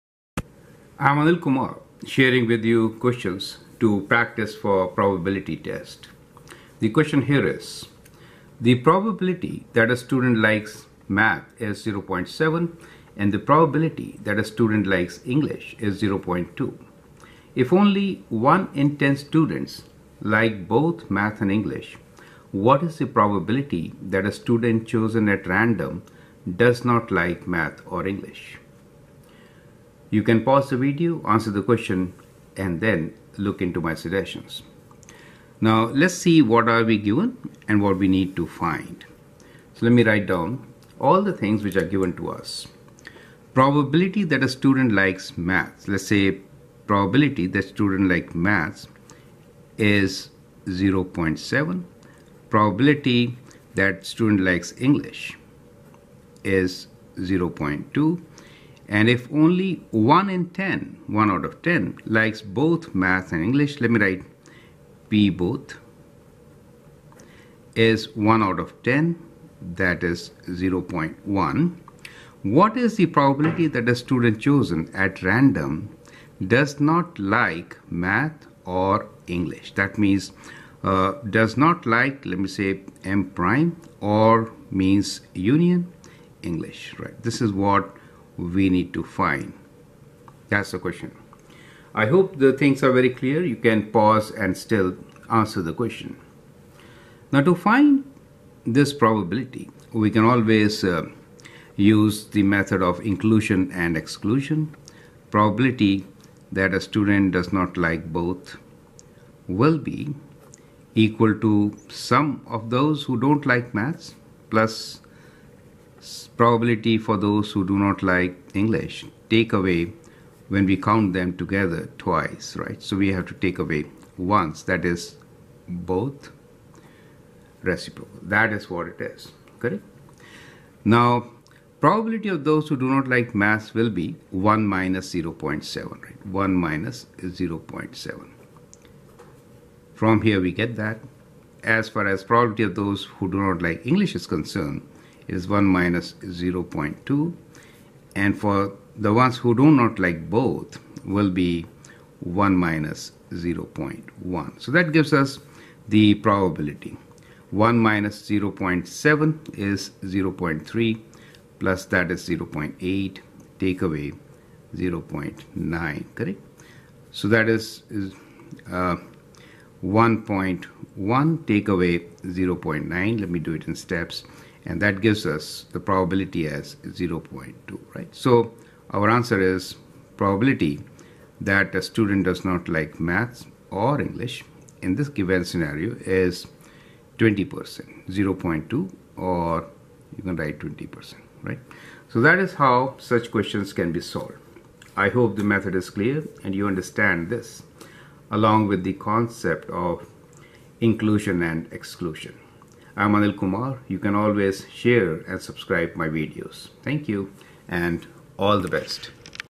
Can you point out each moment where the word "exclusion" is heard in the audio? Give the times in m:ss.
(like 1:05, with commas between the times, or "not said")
1:43, 3:21.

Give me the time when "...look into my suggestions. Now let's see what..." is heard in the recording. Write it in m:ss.
0:33.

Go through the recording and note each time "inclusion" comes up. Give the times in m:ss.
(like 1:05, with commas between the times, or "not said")
1:43, 3:20.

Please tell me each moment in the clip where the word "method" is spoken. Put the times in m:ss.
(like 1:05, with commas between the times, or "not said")
1:42, 3:15.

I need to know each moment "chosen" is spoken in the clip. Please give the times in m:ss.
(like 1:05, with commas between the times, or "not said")
0:24, 1:14.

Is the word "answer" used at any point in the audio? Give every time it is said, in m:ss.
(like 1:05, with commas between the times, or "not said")
0:31, 1:35, 2:59.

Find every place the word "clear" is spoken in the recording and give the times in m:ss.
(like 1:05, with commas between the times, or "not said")
1:33, 3:15.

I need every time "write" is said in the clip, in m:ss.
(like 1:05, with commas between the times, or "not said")
0:40, 1:04, 3:10.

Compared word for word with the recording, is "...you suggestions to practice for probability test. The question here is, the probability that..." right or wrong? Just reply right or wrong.
wrong.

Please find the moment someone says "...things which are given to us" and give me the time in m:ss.
0:41.